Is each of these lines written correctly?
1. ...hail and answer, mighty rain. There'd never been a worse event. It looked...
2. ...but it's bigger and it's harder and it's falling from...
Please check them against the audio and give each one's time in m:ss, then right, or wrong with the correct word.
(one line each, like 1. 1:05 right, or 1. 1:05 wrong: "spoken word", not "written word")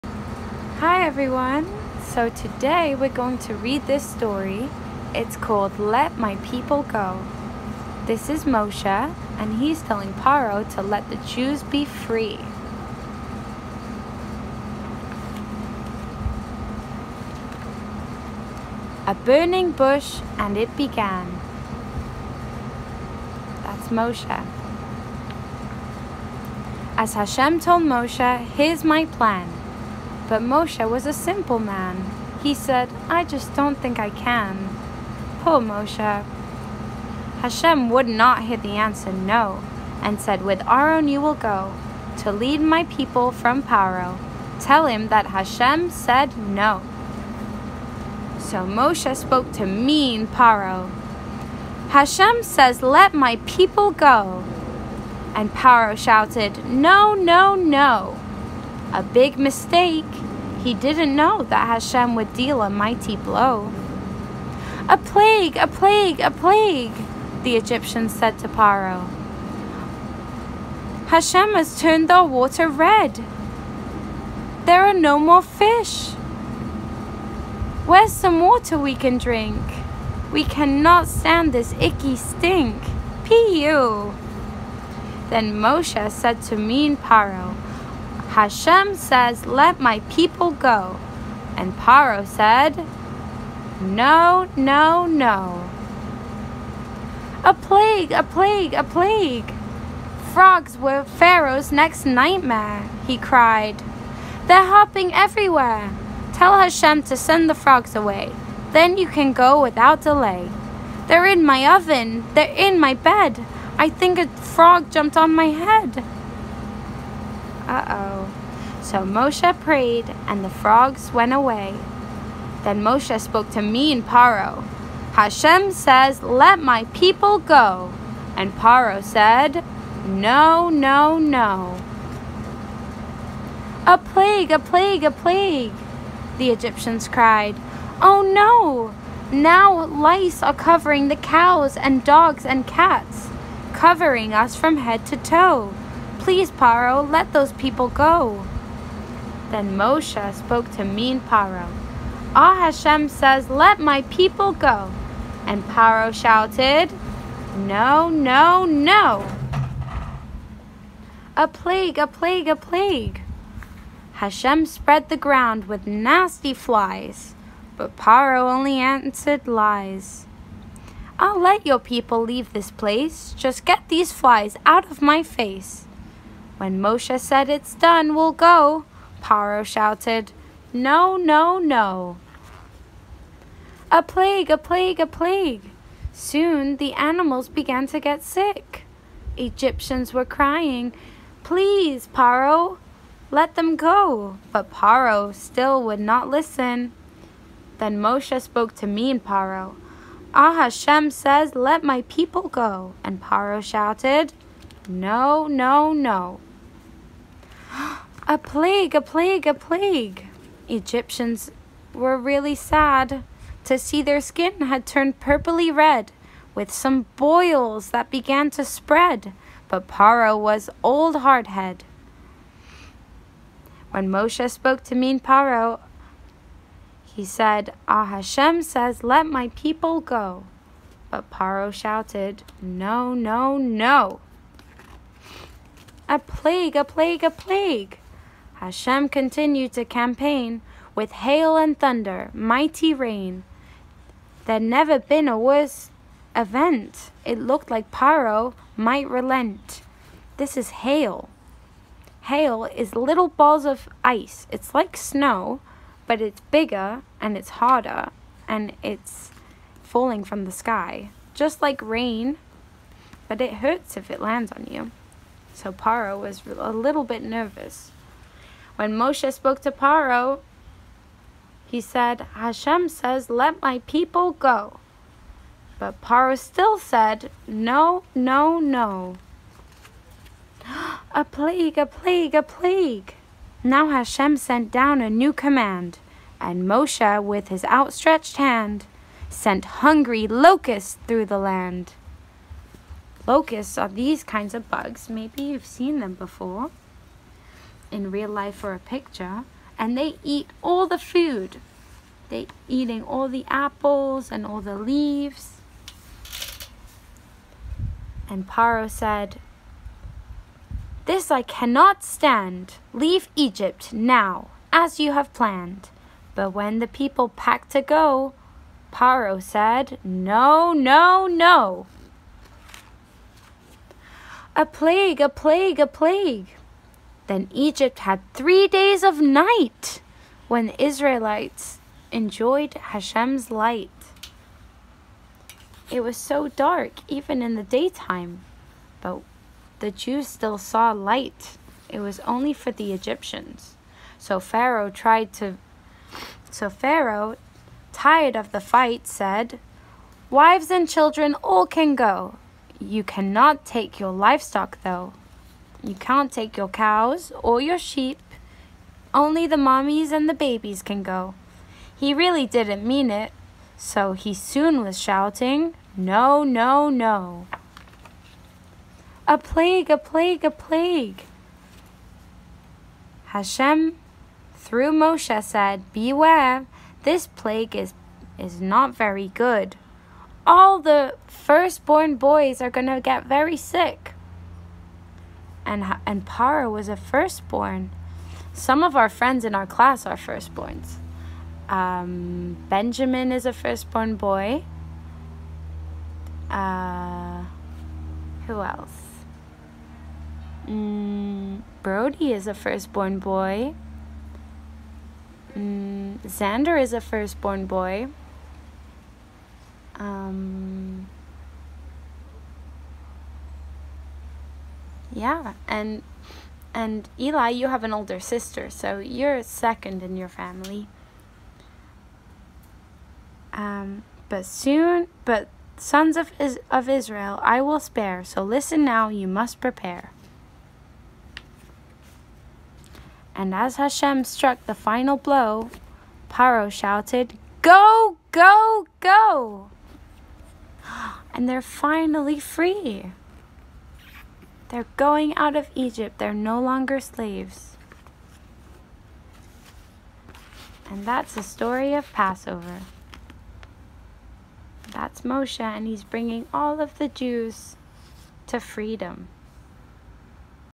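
1. 4:01 wrong: "thunder", not "answer"
2. 4:16 right.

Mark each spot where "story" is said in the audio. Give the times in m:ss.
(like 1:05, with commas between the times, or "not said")
0:04, 7:31.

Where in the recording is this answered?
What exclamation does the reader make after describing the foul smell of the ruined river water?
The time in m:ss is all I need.
1:23.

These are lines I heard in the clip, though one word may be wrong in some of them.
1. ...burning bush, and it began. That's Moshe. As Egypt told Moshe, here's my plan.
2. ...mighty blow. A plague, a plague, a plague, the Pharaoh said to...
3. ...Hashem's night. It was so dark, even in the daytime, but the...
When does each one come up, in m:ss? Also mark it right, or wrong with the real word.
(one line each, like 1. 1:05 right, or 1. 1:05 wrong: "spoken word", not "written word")
1. 0:19 wrong: "Hashem", not "Egypt"
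2. 1:02 wrong: "Egyptians", not "Pharaoh"
3. 5:32 wrong: "light", not "night".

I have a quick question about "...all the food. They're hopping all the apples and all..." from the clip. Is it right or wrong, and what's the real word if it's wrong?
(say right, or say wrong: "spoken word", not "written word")
wrong: "eating", not "hopping".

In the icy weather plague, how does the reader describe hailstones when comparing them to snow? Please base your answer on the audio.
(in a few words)
Little balls of ice.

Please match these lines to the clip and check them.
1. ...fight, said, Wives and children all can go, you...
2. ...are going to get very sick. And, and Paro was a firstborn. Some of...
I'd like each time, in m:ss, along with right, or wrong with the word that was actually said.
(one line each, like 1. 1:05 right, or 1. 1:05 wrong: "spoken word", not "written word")
1. 5:48 right
2. 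6:22 right.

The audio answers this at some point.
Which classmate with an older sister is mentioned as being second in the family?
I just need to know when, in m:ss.
6:57.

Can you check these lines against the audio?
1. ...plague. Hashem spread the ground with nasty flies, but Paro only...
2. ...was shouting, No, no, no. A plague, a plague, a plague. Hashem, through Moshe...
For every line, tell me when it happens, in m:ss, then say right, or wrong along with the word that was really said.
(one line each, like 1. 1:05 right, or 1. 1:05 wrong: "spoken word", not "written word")
1. 2:42 right
2. 6:04 right.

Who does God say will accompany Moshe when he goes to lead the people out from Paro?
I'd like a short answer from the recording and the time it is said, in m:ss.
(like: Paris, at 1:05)
Aaron, at 0:40.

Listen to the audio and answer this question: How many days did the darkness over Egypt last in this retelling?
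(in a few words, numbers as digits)
3.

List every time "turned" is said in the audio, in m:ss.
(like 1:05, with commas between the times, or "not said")
1:11, 3:34.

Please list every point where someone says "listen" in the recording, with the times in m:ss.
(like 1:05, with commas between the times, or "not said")
3:16, 7:08.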